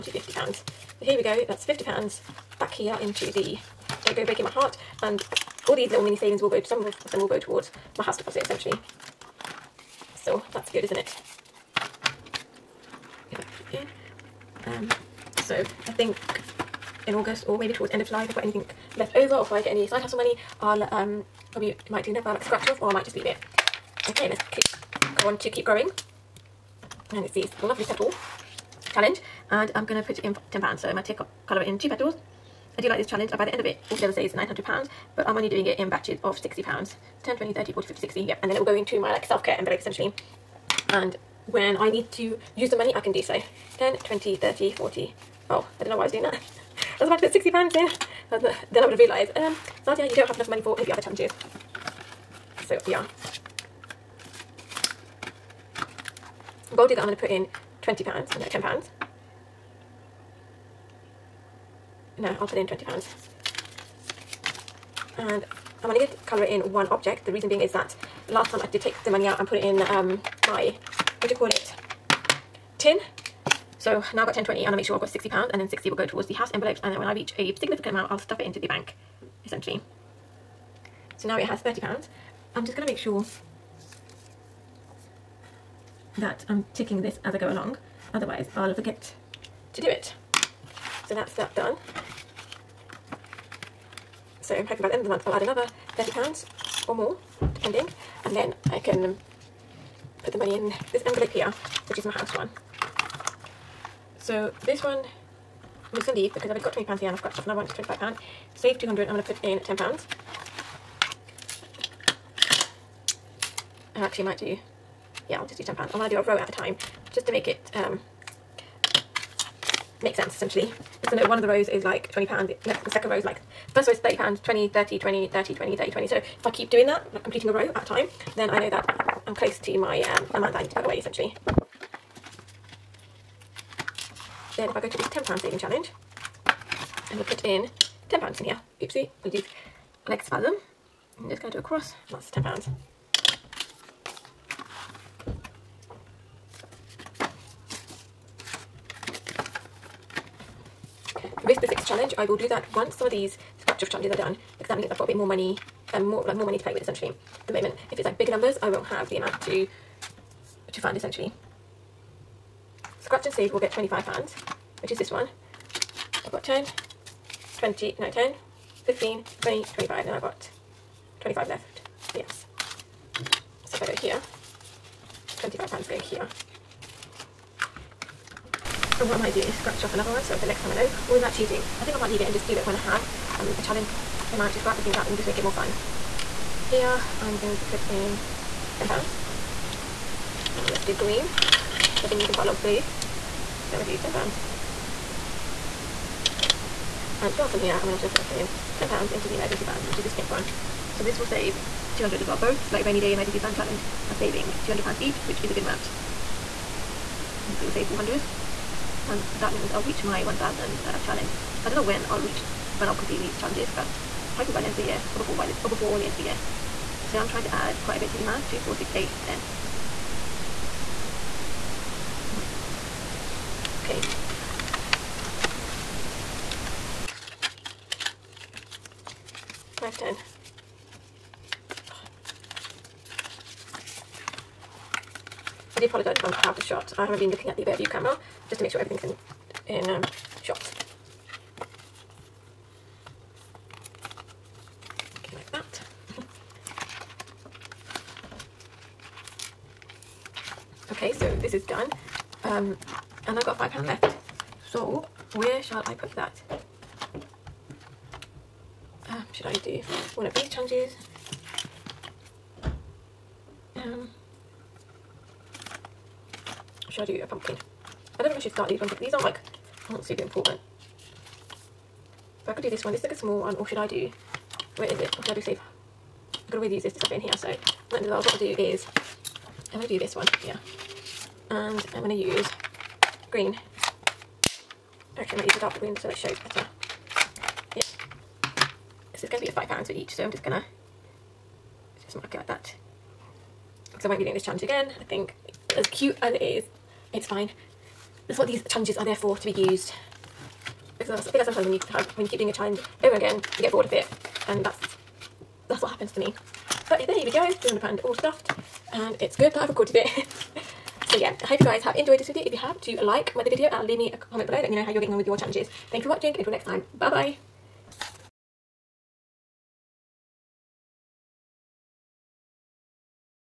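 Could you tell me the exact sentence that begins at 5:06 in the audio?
But there we go, £200 all stuffed and it's good that I've recorded it.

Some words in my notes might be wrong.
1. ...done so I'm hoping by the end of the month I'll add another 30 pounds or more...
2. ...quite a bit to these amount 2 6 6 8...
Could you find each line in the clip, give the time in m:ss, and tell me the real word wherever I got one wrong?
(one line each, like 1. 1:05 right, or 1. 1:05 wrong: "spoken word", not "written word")
1. 1:31 right
2. 3:37 wrong: "4", not "6".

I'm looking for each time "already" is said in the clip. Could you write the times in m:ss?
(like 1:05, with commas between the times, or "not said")
1:46.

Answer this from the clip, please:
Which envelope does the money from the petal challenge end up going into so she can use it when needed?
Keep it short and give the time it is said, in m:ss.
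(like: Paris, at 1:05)
self-care envelope, at 0:39.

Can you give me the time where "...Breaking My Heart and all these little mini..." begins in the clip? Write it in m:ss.
0:04.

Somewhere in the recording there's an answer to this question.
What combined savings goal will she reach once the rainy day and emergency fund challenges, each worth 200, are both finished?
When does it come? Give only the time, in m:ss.
3:30.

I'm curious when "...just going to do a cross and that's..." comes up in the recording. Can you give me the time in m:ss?
2:21.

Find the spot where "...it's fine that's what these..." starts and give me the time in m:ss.
4:57.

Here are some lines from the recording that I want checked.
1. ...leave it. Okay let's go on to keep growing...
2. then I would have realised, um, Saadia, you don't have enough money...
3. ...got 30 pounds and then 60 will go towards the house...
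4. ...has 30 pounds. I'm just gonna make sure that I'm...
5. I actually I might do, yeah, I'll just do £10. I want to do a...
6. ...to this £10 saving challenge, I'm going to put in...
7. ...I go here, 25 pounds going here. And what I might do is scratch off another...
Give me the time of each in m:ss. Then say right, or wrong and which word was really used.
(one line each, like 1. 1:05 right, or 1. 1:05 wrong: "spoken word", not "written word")
1. 0:23 right
2. 0:48 right
3. 1:15 wrong: "60", not "30"
4. 1:21 right
5. 1:53 right
6. 2:14 right
7. 2:53 right.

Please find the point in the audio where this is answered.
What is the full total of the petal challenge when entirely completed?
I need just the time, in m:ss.
0:34.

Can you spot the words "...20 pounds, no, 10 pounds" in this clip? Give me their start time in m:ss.
0:57.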